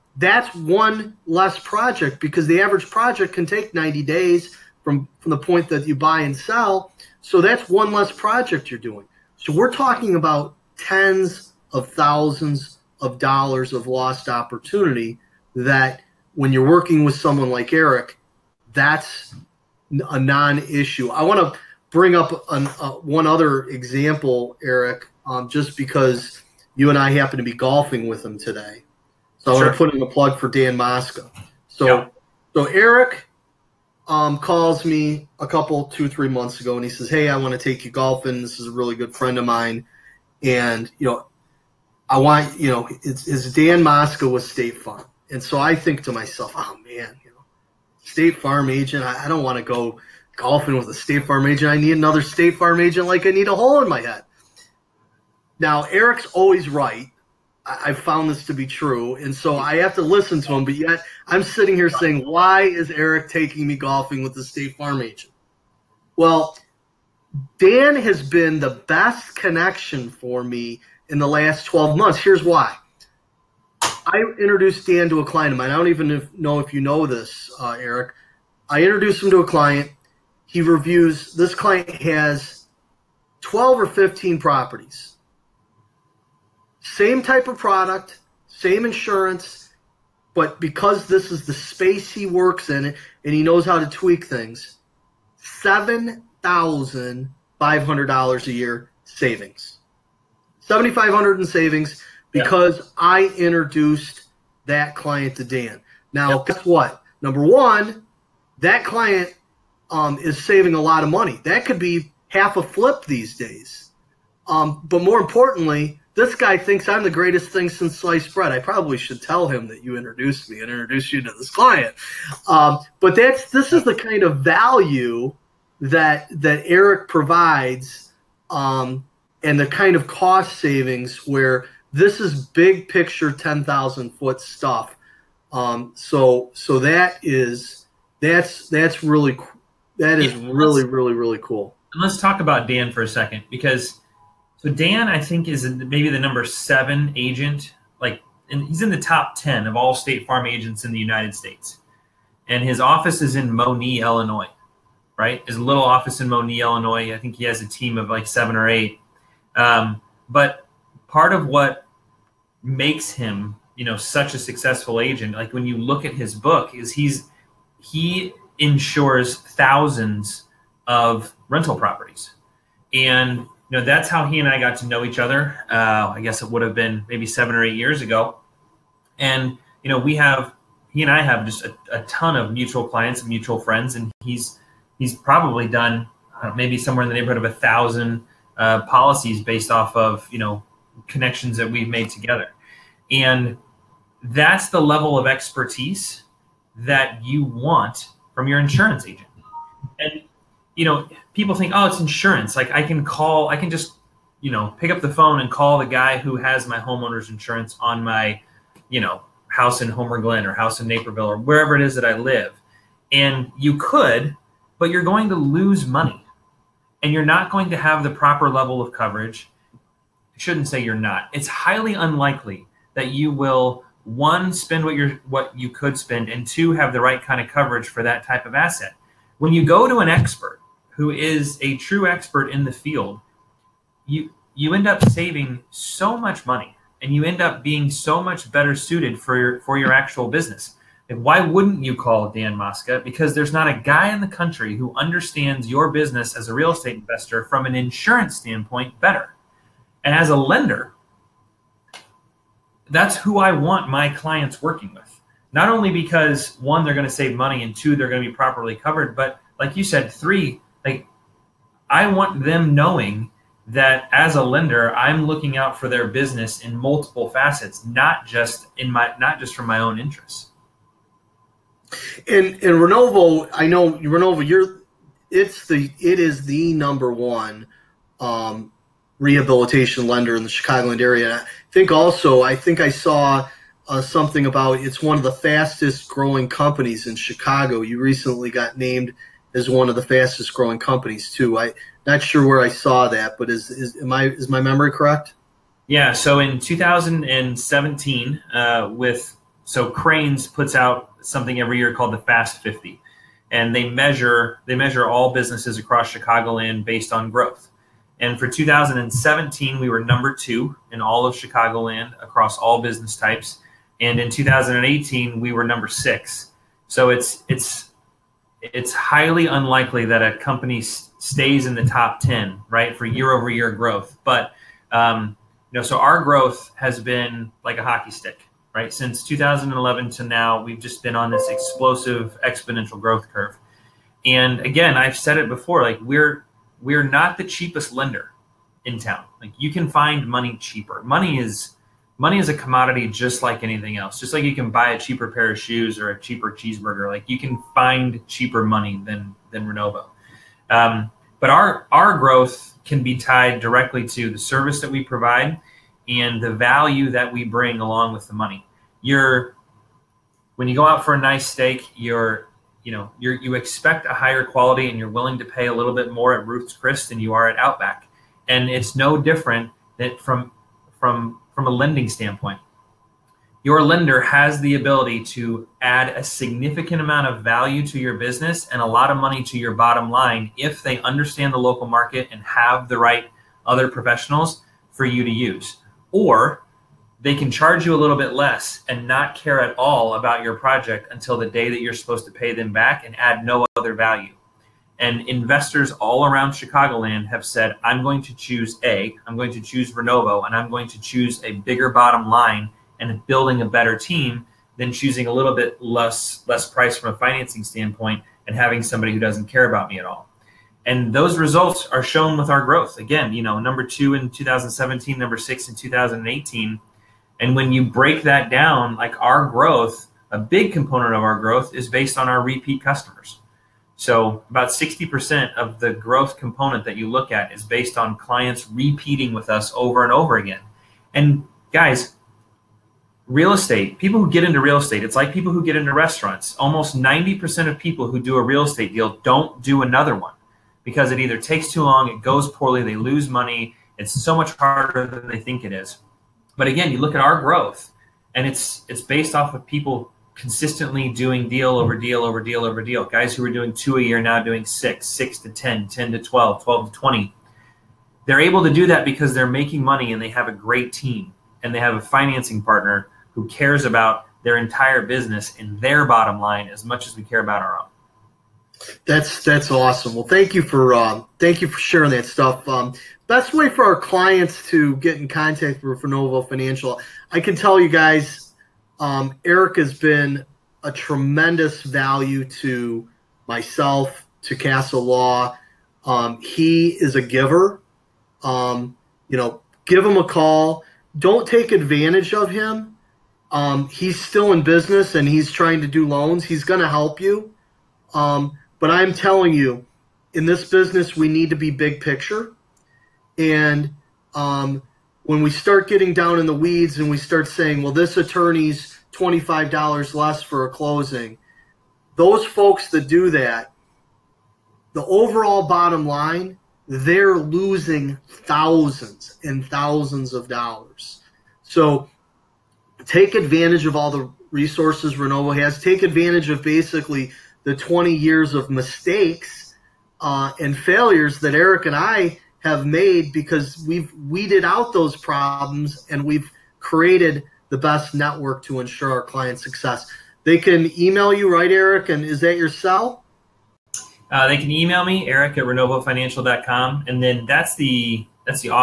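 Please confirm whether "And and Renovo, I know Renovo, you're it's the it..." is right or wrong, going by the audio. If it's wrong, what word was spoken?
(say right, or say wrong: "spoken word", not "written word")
right.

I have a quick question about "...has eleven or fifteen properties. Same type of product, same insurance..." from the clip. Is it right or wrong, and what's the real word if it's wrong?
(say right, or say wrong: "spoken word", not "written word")
wrong: "twelve", not "eleven".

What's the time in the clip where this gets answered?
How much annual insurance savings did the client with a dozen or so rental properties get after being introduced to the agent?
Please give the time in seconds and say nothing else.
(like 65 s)
95 s.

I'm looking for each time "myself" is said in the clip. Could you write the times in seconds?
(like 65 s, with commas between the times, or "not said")
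46 s, 483 s.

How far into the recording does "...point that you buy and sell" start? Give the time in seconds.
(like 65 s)
5 s.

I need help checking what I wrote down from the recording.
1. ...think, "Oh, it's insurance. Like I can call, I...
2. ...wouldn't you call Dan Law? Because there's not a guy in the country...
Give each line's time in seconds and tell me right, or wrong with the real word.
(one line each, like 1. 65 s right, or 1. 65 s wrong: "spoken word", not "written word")
1. 201 s right
2. 241 s wrong: "Mosca", not "Law".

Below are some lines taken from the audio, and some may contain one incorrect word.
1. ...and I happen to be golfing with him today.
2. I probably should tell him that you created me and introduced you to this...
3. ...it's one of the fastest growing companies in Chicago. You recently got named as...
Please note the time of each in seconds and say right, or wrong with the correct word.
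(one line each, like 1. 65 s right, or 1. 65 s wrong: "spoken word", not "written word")
1. 26 s right
2. 118 s wrong: "introduced", not "created"
3. 284 s right.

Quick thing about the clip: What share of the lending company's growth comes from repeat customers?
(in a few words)
60%.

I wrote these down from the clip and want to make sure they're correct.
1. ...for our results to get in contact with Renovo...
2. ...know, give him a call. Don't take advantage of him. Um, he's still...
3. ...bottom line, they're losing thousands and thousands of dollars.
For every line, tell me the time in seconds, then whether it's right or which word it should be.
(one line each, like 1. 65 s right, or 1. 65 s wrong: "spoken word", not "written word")
1. 473 s wrong: "clients", not "results"
2. 489 s right
3. 515 s right.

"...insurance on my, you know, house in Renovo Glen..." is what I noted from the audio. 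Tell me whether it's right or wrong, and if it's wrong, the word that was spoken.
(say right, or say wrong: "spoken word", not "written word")
wrong: "Homer", not "Renovo".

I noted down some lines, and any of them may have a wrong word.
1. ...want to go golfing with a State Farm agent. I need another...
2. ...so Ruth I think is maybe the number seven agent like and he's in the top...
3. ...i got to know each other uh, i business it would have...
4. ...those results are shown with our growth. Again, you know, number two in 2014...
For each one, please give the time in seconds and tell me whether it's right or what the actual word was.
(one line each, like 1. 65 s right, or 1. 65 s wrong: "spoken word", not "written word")
1. 49 s right
2. 144 s wrong: "Dan", not "Ruth"
3. 174 s wrong: "guess", not "business"
4. 411 s wrong: "2017", not "2014".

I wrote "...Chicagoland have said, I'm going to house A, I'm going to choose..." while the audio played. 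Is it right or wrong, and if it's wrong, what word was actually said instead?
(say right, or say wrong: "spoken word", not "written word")
wrong: "choose", not "house".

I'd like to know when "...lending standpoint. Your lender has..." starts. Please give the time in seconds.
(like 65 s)
371 s.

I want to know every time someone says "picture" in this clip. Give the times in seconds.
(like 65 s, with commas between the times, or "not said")
132 s, 501 s.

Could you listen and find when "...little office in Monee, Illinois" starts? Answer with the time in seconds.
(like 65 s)
155 s.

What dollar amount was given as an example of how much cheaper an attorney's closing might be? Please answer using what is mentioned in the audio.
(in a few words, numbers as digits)
$25.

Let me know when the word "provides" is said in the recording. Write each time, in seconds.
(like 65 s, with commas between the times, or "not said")
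127 s, 355 s.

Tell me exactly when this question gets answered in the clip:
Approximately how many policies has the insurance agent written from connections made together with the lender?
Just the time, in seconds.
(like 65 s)
187 s.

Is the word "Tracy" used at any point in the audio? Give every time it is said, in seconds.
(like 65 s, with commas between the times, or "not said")
not said.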